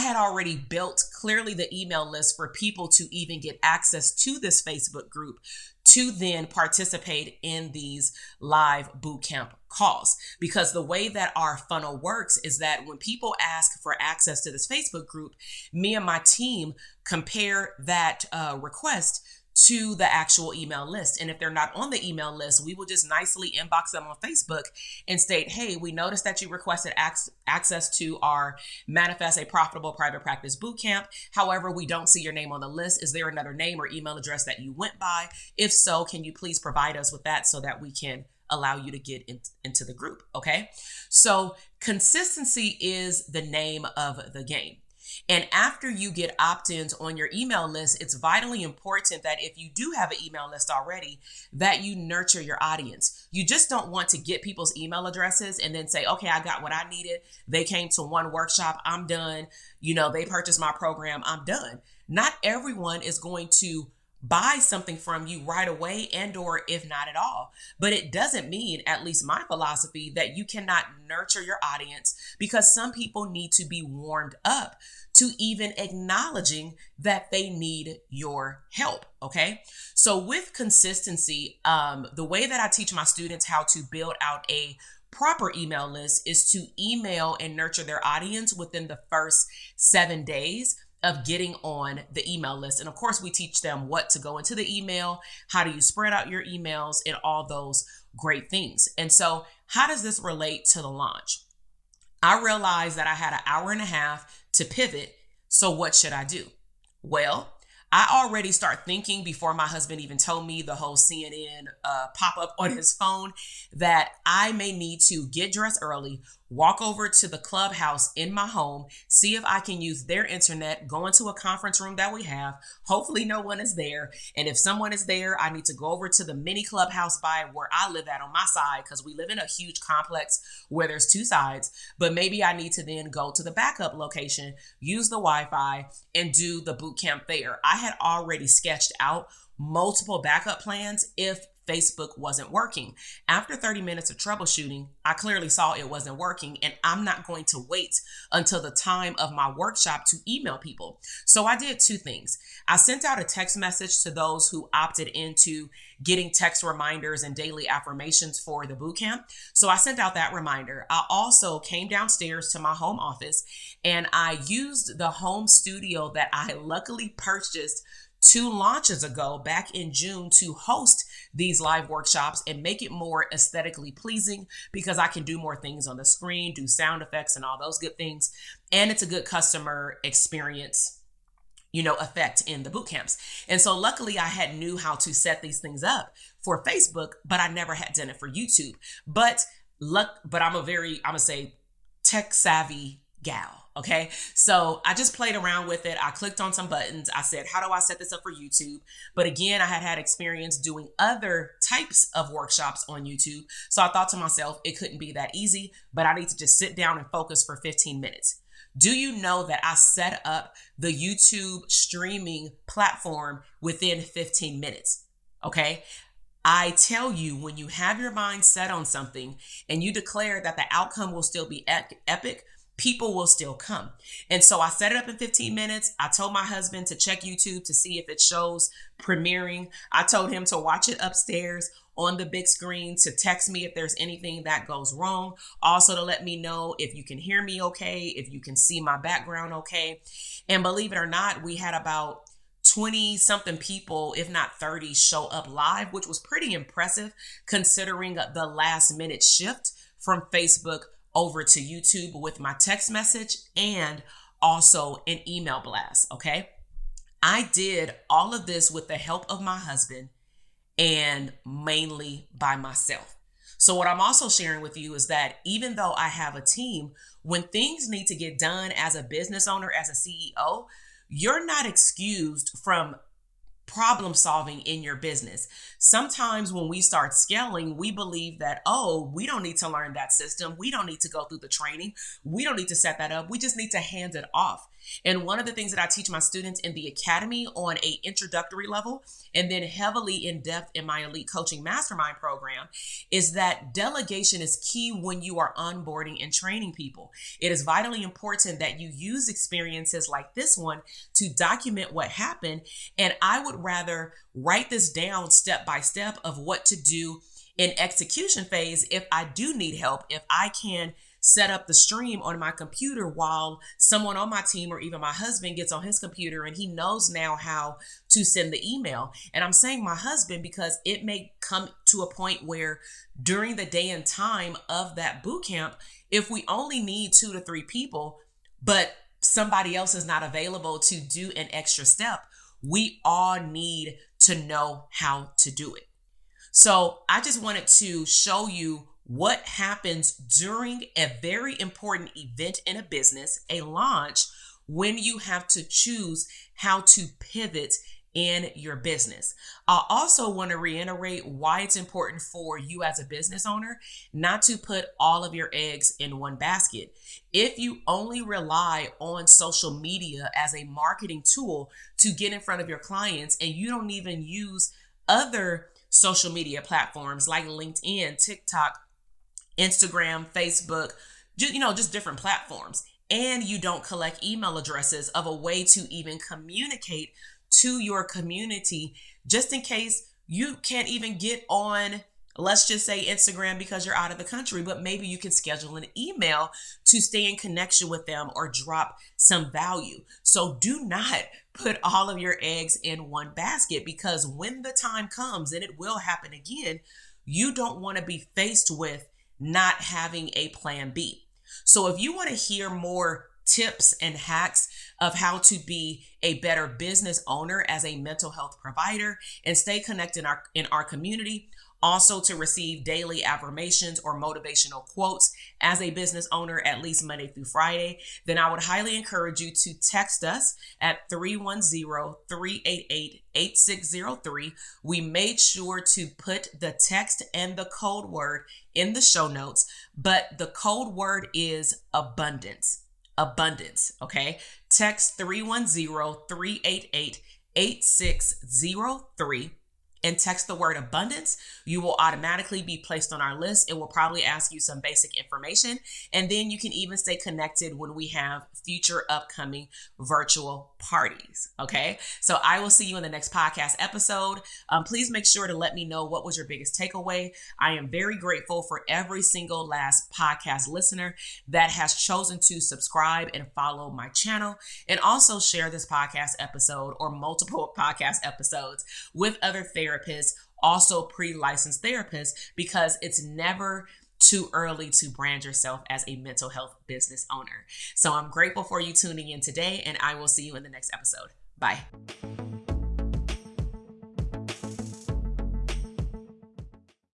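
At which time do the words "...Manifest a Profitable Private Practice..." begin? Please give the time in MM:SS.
00:28.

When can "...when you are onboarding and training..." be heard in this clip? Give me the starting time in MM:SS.
04:54.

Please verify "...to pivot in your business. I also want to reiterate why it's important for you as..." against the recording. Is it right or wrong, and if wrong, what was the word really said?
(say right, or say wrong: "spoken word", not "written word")
right.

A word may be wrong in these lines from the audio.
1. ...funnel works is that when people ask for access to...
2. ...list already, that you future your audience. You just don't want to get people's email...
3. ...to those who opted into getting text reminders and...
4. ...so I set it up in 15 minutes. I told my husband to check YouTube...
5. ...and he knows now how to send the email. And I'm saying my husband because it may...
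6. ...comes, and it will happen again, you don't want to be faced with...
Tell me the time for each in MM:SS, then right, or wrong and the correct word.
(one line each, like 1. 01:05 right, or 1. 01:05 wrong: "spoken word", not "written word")
1. 00:11 right
2. 00:50 wrong: "nurture", not "future"
3. 02:34 right
4. 03:44 right
5. 05:16 right
6. 06:35 right.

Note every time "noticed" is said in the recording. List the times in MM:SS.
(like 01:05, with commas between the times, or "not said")
00:25.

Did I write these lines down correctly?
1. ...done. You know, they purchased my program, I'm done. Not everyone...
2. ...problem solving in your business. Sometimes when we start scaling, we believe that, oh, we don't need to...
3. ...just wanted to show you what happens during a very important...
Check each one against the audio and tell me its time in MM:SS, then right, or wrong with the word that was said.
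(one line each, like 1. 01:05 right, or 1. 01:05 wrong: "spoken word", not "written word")
1. 00:59 right
2. 04:33 right
3. 05:37 right.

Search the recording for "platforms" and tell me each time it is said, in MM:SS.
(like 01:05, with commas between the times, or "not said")
03:32, 06:06, 06:12.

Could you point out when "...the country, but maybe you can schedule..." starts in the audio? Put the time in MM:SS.
06:24.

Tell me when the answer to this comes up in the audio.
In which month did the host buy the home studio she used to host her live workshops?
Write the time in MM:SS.
02:49.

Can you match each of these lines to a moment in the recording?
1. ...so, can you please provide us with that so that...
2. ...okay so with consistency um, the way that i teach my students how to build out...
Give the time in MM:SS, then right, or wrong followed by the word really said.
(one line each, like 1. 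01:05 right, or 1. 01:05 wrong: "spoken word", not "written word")
1. 00:35 right
2. 01:19 right.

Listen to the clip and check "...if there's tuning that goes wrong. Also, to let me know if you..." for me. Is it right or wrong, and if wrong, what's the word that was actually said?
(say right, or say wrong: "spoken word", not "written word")
wrong: "anything", not "tuning".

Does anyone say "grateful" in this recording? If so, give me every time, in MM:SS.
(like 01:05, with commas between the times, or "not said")
07:38, 07:58.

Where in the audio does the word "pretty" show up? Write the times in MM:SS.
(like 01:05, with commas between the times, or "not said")
04:06.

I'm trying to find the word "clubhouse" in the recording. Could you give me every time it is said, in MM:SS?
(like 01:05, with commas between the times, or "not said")
01:57, 02:06.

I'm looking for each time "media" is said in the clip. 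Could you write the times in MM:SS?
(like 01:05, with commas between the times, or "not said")
05:59, 06:06.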